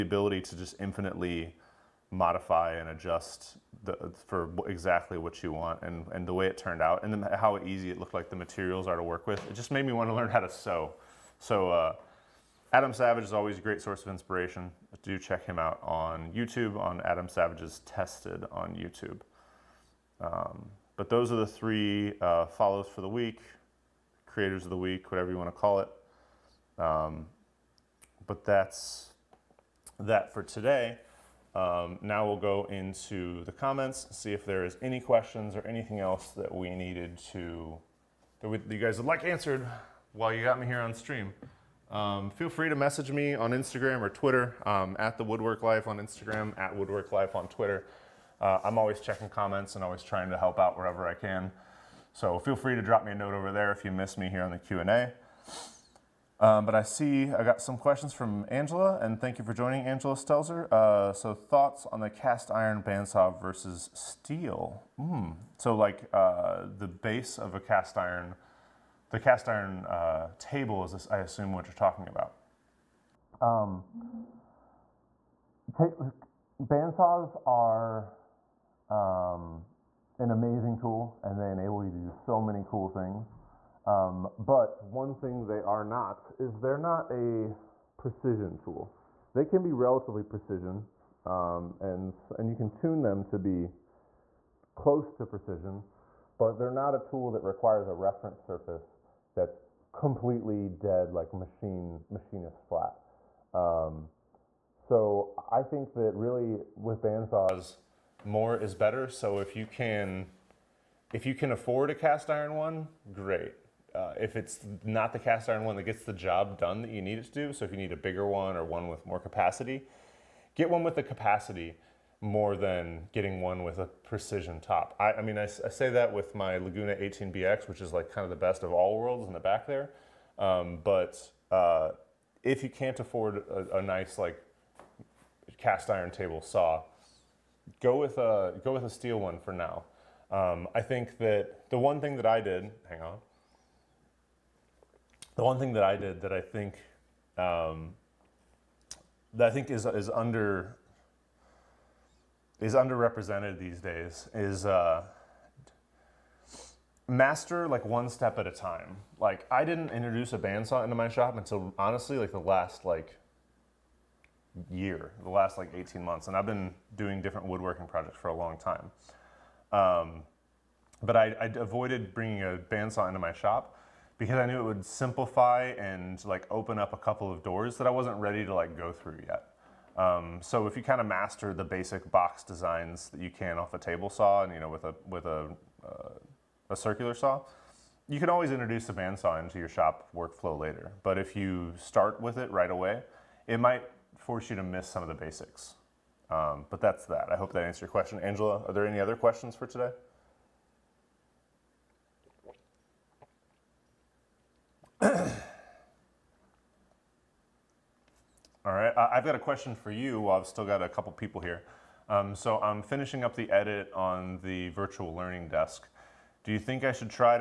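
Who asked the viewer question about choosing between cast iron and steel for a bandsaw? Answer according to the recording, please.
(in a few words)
Angela Stelzer.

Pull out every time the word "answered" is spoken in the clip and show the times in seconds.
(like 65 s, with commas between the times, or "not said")
39 s, 197 s.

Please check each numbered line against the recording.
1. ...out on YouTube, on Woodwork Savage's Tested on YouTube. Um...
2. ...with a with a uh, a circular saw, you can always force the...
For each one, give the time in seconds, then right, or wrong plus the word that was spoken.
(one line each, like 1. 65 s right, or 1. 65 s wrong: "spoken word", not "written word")
1. 15 s wrong: "Adam", not "Woodwork"
2. 184 s wrong: "introduce", not "force".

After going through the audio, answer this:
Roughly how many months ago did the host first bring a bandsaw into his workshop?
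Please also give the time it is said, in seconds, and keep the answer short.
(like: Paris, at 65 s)
18, at 165 s.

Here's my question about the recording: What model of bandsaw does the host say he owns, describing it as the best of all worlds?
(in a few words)
Laguna 18BX.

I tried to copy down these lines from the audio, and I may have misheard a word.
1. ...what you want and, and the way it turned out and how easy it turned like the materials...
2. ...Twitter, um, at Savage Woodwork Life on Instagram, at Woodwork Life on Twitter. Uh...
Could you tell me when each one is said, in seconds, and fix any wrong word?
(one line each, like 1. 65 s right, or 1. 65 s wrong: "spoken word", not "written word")
1. 5 s wrong: "looked", not "turned"
2. 44 s wrong: "The", not "Savage".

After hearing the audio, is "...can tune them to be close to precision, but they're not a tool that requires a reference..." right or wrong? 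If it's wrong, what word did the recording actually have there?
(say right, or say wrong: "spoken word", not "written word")
right.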